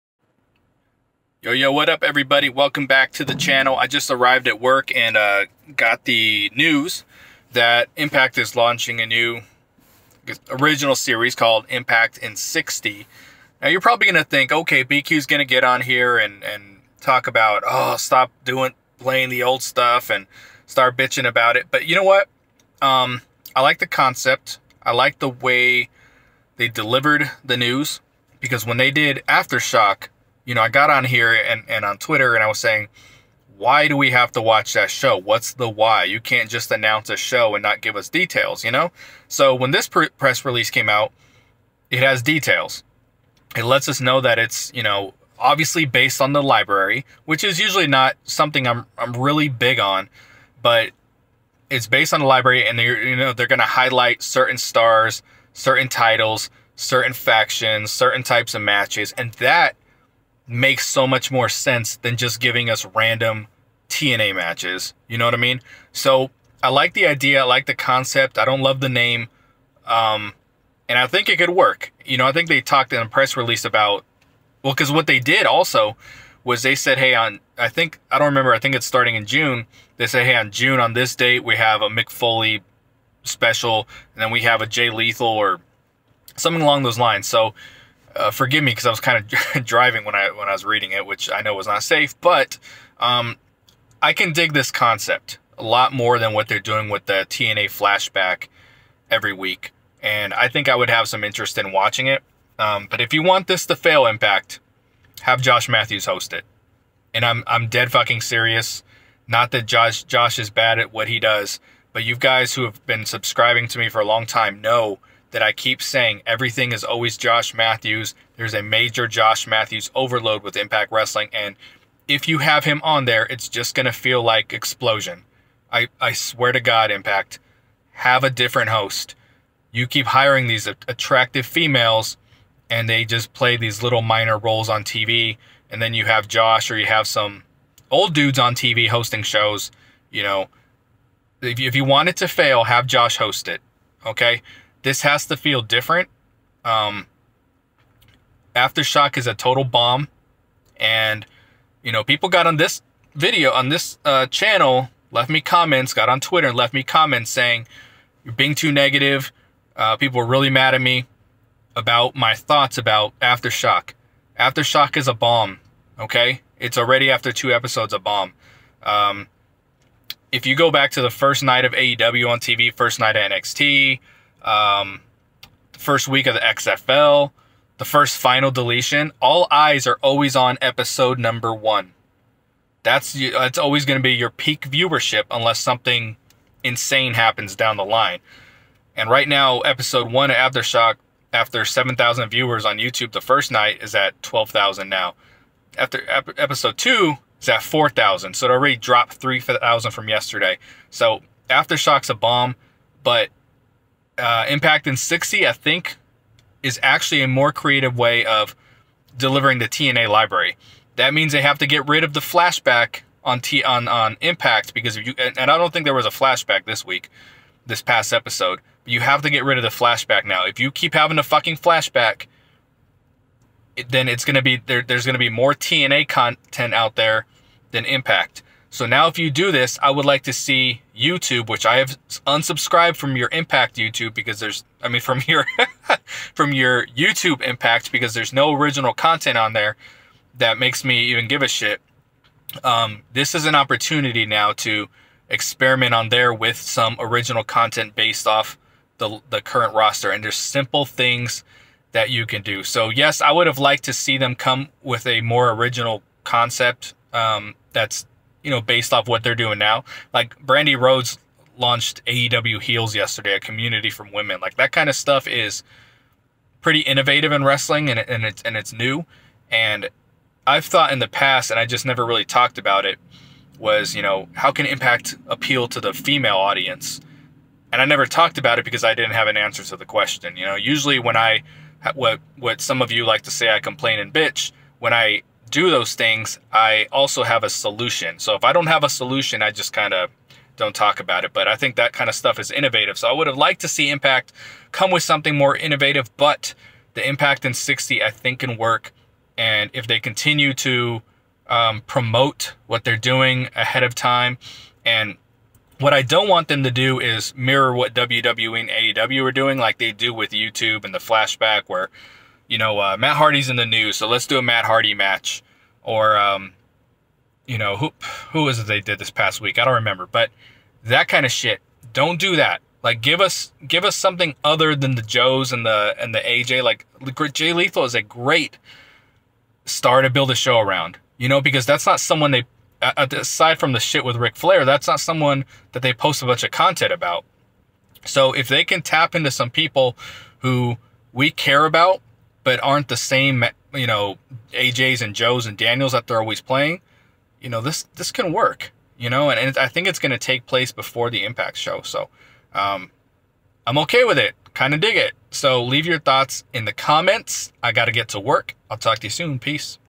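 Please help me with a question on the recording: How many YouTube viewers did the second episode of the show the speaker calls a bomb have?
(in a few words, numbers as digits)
4,000.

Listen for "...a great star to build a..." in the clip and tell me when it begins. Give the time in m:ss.
5:27.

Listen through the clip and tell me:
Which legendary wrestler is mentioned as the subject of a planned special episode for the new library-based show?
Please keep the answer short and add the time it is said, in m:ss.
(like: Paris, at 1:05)
Mick Foley, at 1:21.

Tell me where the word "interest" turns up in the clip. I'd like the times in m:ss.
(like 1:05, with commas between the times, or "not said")
1:41.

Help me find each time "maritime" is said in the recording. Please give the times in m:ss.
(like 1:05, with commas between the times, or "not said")
not said.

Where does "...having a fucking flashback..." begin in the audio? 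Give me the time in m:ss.
3:40.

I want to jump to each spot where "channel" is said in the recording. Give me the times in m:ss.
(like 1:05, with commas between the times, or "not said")
0:03, 2:34.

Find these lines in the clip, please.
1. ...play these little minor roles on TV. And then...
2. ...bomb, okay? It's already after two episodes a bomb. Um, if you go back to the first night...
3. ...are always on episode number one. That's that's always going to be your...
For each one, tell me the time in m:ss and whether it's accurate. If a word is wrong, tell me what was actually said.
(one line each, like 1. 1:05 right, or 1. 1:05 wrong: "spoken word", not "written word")
1. 2:13 right
2. 2:45 right
3. 2:59 right.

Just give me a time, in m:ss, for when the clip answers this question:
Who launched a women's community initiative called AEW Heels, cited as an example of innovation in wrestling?
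4:20.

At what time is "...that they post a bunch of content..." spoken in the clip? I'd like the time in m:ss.
5:35.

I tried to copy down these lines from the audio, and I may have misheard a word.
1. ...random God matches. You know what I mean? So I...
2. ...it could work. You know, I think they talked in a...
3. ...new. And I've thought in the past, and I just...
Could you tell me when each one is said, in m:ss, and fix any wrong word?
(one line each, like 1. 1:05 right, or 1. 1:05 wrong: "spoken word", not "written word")
1. 1:02 wrong: "TNA", not "God"
2. 1:11 right
3. 4:28 right.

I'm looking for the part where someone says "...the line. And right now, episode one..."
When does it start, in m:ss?
3:07.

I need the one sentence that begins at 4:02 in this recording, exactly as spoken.
Um, this is an opportunity now to experiment on there with some original content based off the, the current roster.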